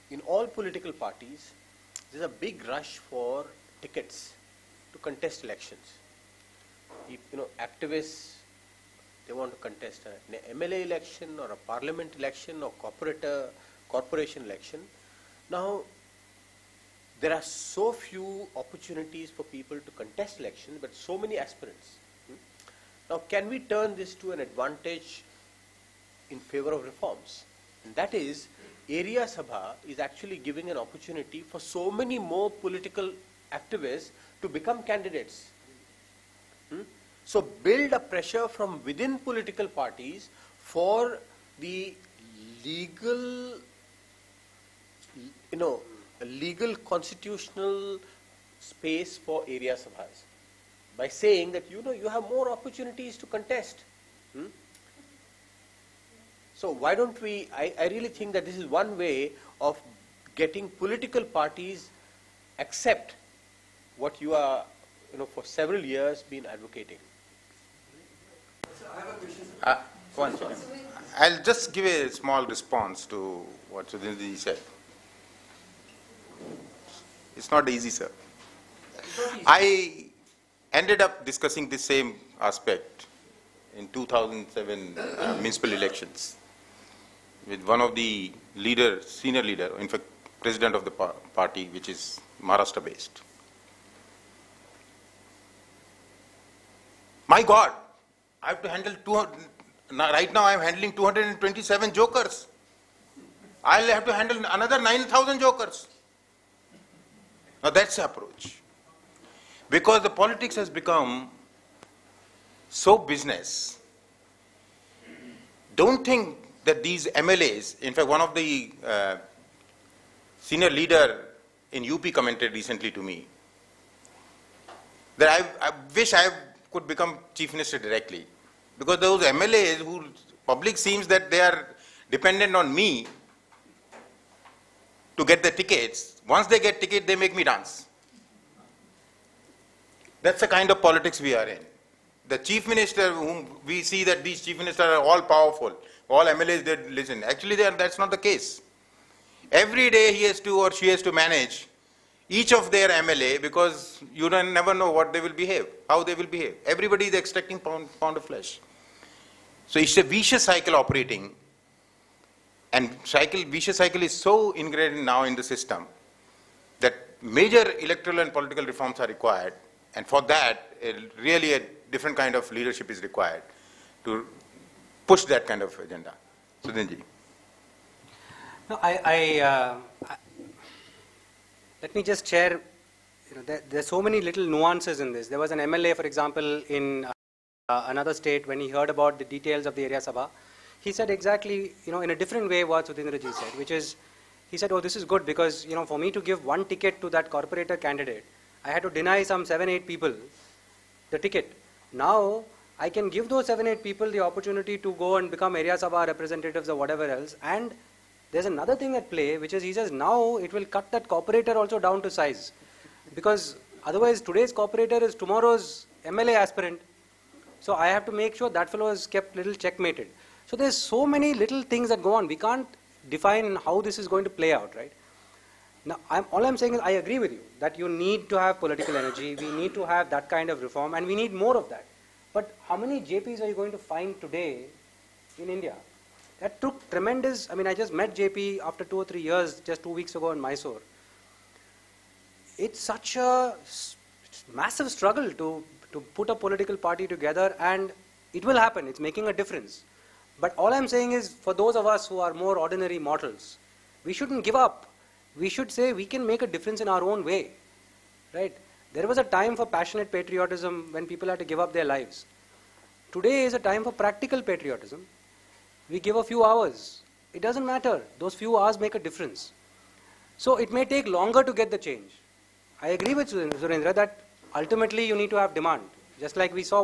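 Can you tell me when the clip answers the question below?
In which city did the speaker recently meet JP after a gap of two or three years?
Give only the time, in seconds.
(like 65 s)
240 s.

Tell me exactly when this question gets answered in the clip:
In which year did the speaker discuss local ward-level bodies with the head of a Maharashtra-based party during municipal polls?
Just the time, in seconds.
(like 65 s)
83 s.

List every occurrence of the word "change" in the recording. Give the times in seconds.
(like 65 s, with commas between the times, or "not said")
271 s.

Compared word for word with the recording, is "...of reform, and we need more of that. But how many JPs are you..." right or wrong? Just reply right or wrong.
right.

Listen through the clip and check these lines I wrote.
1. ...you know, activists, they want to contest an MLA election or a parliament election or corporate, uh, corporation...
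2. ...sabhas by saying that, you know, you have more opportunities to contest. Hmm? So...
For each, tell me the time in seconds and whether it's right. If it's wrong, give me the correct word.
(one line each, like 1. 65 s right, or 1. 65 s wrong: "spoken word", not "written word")
1. 7 s right
2. 49 s right.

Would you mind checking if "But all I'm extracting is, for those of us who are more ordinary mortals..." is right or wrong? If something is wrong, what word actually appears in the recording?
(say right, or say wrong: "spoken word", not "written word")
wrong: "saying", not "extracting".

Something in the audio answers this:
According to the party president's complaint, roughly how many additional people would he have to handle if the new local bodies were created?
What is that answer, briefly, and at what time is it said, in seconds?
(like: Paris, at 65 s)
9,000, at 104 s.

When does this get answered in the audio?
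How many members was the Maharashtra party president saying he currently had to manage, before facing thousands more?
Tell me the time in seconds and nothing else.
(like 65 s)
100 s.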